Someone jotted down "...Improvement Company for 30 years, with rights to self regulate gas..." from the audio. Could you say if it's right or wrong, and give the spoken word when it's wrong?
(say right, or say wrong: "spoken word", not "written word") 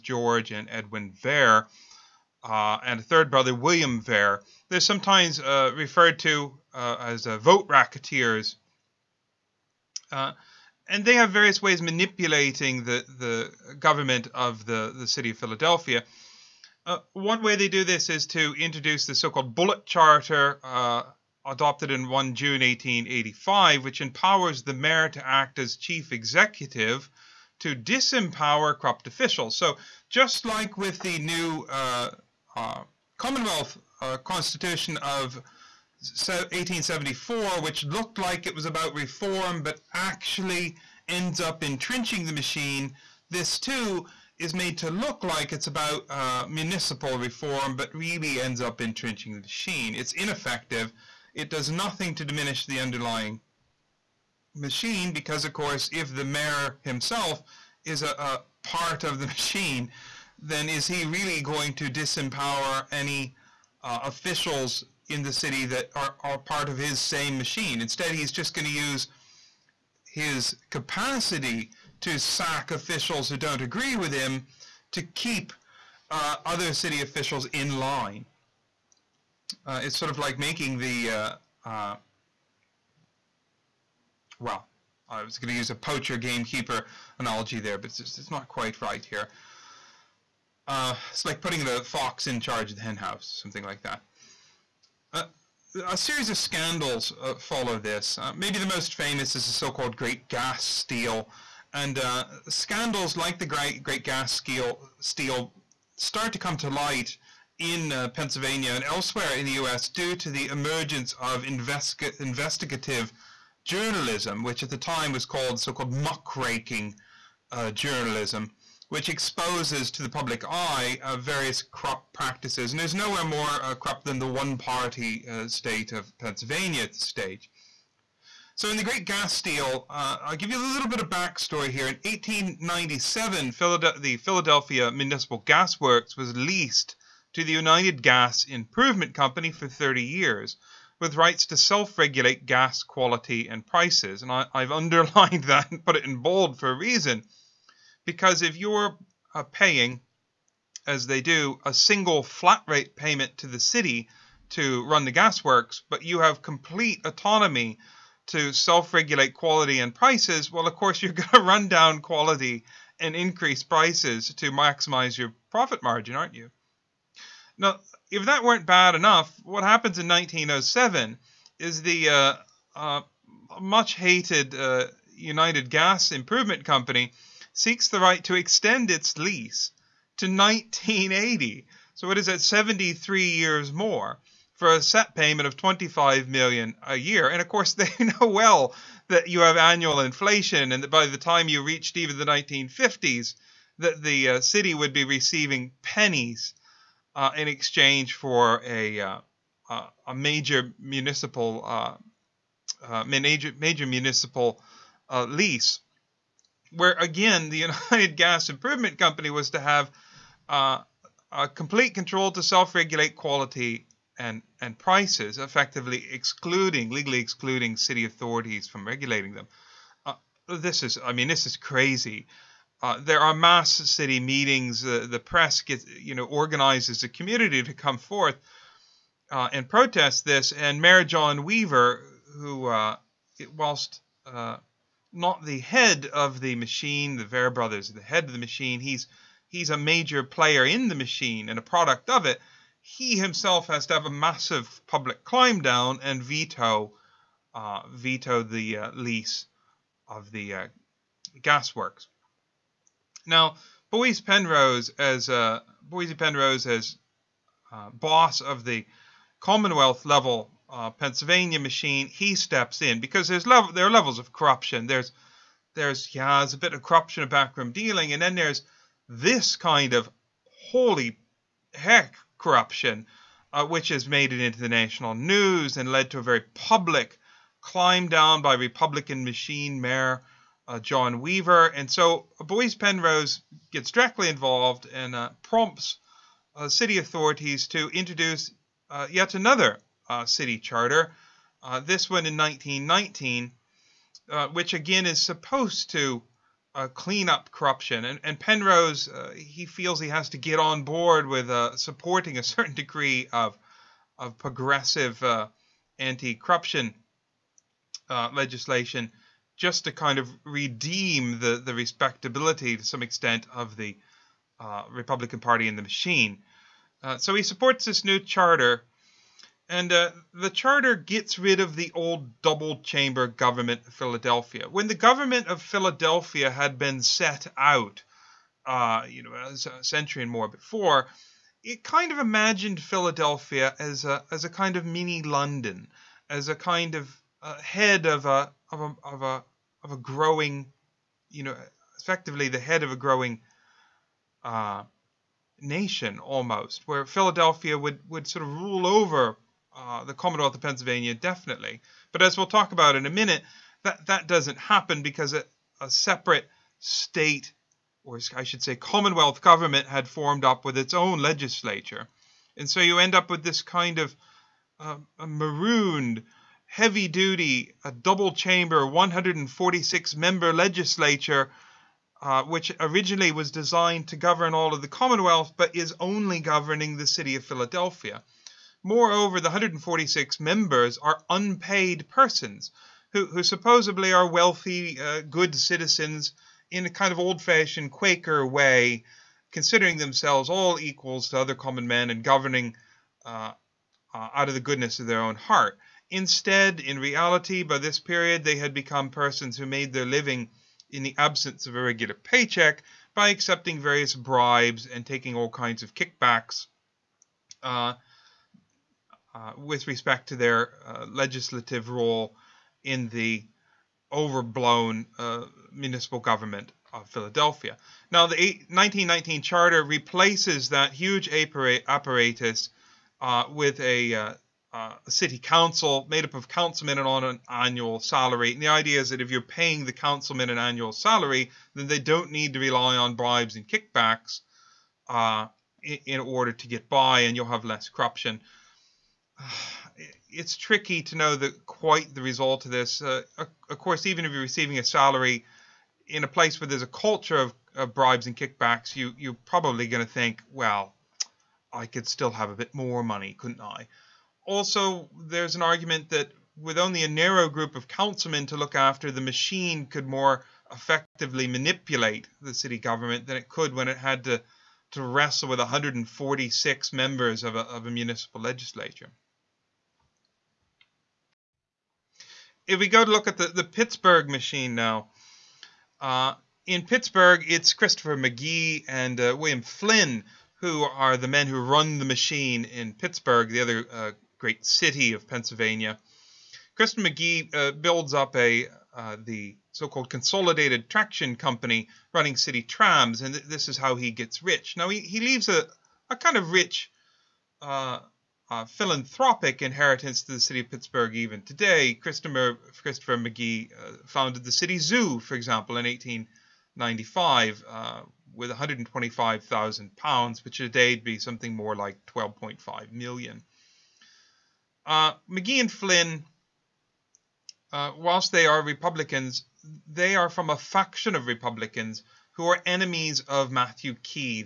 right.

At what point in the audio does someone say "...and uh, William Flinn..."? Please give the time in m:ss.
7:58.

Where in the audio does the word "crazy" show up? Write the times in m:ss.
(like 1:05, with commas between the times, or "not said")
3:41.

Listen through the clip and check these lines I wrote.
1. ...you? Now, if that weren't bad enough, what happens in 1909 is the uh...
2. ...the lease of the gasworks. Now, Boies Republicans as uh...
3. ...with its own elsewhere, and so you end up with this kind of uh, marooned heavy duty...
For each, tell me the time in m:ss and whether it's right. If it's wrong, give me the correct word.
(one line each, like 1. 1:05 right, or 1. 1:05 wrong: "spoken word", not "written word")
1. 2:46 wrong: "1907", not "1909"
2. 4:08 wrong: "Penrose", not "Republicans"
3. 6:00 wrong: "legislature", not "elsewhere".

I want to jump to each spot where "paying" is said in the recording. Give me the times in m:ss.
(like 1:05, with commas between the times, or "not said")
2:29, 7:09.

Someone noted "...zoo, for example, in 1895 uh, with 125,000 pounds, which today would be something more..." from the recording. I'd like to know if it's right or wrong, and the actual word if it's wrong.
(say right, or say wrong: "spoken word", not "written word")
right.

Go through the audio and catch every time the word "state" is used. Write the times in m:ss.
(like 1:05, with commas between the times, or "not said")
2:05, 5:56.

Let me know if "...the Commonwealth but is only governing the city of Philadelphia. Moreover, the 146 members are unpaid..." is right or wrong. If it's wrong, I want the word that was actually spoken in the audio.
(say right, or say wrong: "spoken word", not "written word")
right.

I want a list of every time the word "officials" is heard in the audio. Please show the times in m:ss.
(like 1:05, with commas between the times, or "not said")
0:29, 1:04, 1:12, 1:17.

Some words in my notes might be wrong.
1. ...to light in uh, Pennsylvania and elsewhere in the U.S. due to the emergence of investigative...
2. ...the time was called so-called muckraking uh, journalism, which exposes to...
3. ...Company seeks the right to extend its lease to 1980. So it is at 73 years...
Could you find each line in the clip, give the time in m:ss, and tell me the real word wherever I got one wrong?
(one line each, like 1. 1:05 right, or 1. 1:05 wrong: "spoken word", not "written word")
1. 1:46 right
2. 1:54 right
3. 2:56 right.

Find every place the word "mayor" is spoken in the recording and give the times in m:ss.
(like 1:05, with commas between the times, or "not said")
0:24, 0:56, 3:50, 4:39.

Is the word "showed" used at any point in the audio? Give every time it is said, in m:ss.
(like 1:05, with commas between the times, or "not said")
not said.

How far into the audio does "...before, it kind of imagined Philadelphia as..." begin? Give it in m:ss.
5:30.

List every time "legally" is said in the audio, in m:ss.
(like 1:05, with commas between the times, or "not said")
3:36.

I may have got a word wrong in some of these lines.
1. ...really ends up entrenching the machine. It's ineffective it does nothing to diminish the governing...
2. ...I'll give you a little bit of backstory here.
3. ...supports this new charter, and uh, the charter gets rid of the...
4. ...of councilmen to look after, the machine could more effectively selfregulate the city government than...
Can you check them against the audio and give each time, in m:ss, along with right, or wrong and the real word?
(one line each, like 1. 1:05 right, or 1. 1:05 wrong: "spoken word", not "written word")
1. 0:47 wrong: "underlying", not "governing"
2. 2:10 right
3. 5:17 right
4. 7:37 wrong: "manipulate", not "selfregulate".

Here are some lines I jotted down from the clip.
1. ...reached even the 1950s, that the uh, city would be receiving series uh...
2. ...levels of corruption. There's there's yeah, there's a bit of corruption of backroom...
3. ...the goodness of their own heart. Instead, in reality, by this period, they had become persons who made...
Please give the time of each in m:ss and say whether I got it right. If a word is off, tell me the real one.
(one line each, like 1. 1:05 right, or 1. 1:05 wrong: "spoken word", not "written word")
1. 3:11 wrong: "pennies", not "series"
2. 4:23 right
3. 6:34 right.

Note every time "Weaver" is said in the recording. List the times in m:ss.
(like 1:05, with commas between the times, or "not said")
3:51, 4:41.